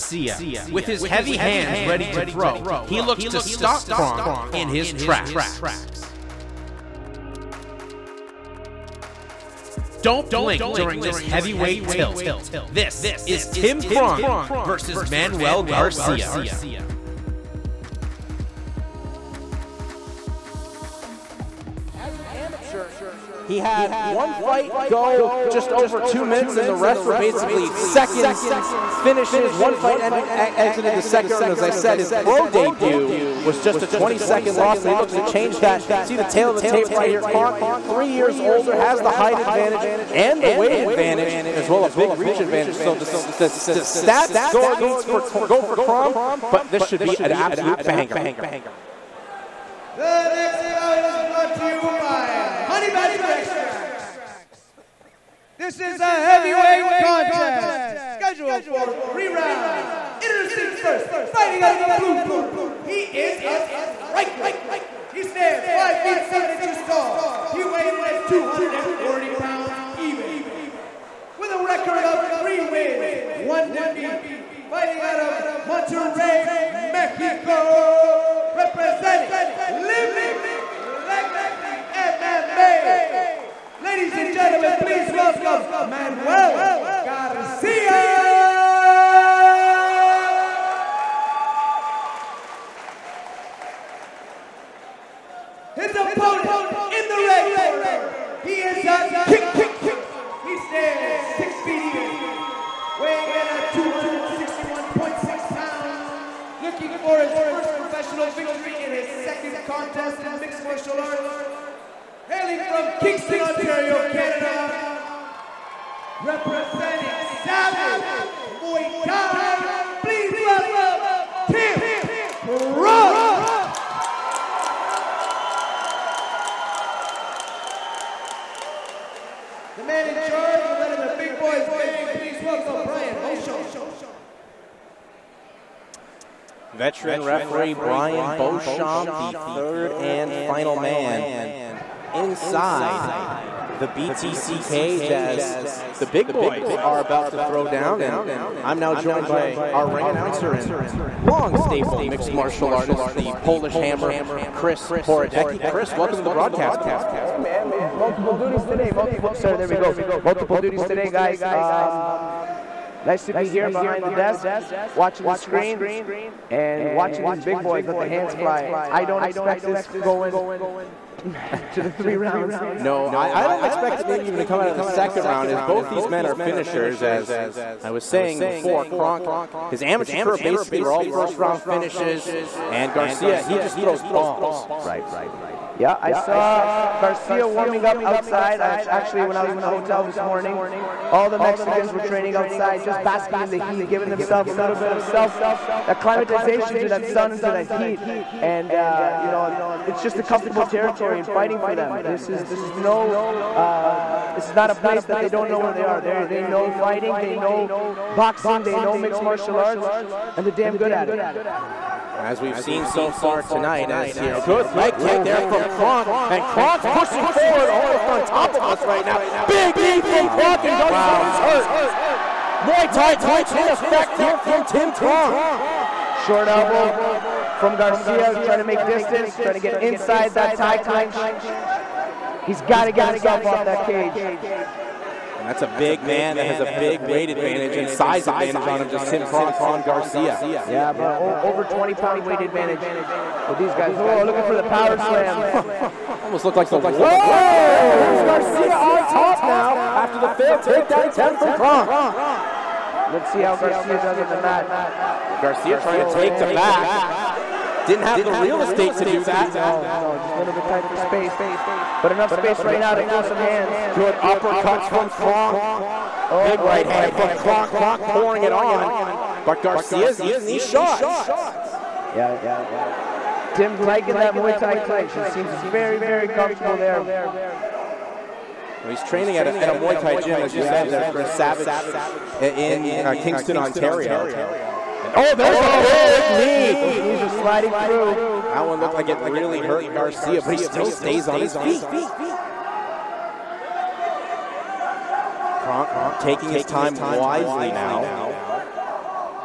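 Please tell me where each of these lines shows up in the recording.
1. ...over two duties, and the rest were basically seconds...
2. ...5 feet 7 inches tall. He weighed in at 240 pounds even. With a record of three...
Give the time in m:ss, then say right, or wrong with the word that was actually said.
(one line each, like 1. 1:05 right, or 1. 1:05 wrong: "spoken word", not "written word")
1. 0:25 wrong: "minutes", not "duties"
2. 1:05 right.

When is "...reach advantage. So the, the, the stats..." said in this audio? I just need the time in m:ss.
0:42.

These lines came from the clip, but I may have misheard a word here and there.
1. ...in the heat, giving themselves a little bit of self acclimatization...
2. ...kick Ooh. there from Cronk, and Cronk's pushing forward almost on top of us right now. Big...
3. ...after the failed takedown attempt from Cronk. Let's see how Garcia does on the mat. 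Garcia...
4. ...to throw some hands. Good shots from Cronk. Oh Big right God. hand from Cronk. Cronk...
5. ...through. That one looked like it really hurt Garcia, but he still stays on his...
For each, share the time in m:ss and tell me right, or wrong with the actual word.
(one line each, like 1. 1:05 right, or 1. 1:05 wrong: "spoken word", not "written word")
1. 3:13 right
2. 3:34 right
3. 4:09 right
4. 4:22 wrong: "uppercuts", not "shots"
5. 4:47 right.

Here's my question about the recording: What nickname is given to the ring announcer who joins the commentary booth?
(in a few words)
the Polish Hammer.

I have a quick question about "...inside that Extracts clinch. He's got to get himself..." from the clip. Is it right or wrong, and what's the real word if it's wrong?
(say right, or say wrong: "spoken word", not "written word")
wrong: "Thai", not "Extracts".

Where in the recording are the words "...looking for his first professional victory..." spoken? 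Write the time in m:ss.
1:46.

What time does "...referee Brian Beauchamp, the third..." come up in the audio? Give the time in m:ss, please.
2:17.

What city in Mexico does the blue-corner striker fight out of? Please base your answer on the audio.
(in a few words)
Monterrey.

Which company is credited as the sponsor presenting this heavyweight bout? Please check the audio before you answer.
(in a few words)
Honey Badger Extracts.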